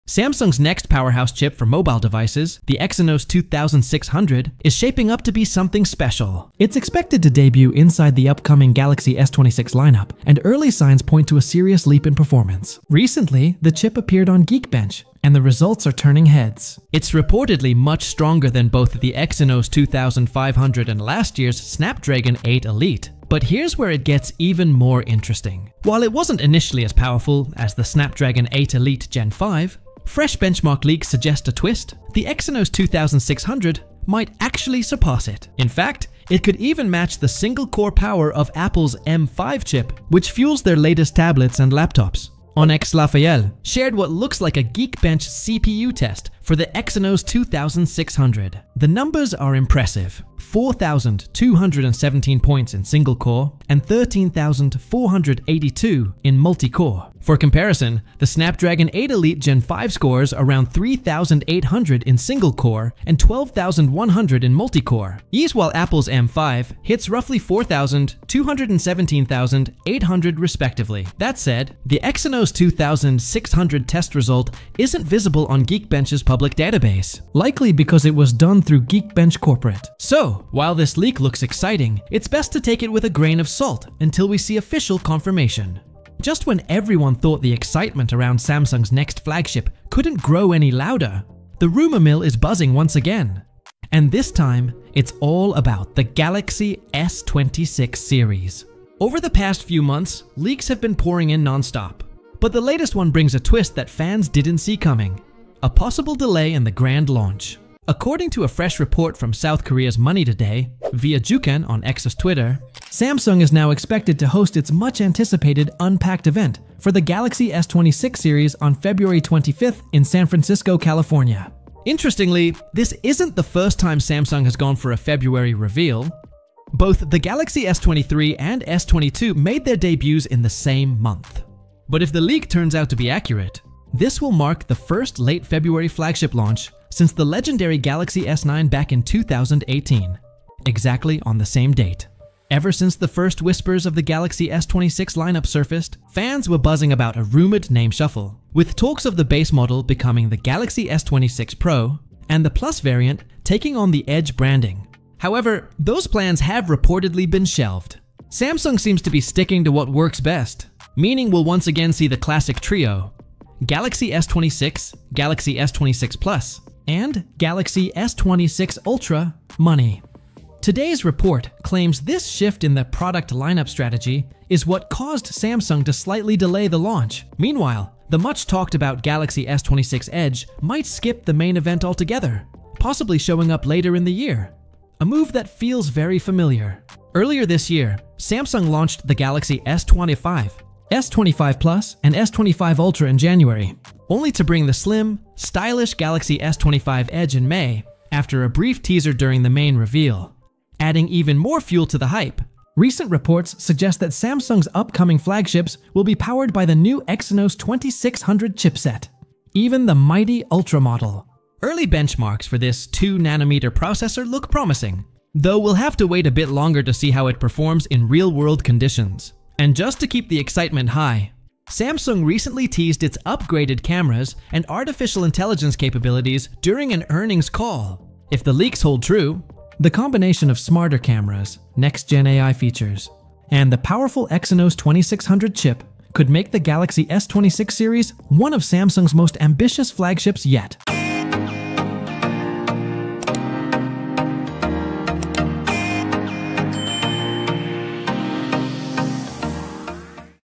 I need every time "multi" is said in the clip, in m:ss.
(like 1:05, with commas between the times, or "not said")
0:56, 1:04.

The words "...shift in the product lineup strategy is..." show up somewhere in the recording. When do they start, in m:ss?
2:52.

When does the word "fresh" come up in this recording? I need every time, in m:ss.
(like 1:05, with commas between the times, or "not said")
0:30, 1:48.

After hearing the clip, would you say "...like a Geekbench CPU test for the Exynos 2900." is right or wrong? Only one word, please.
wrong.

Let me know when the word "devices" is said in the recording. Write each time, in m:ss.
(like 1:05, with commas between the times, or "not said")
0:01.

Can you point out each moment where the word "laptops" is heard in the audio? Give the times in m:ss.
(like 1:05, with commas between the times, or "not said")
0:41.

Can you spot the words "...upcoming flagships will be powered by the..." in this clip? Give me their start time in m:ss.
3:24.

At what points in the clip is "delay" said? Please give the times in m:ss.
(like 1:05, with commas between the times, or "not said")
1:46, 2:56.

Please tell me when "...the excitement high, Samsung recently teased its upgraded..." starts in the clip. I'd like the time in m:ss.
3:40.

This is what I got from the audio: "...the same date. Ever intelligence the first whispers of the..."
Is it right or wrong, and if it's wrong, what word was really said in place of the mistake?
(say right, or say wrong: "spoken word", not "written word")
wrong: "since", not "intelligence".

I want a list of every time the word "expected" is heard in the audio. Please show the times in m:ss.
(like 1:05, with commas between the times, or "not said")
0:06, 1:53.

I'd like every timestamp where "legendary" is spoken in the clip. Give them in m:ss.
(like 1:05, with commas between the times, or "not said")
2:17.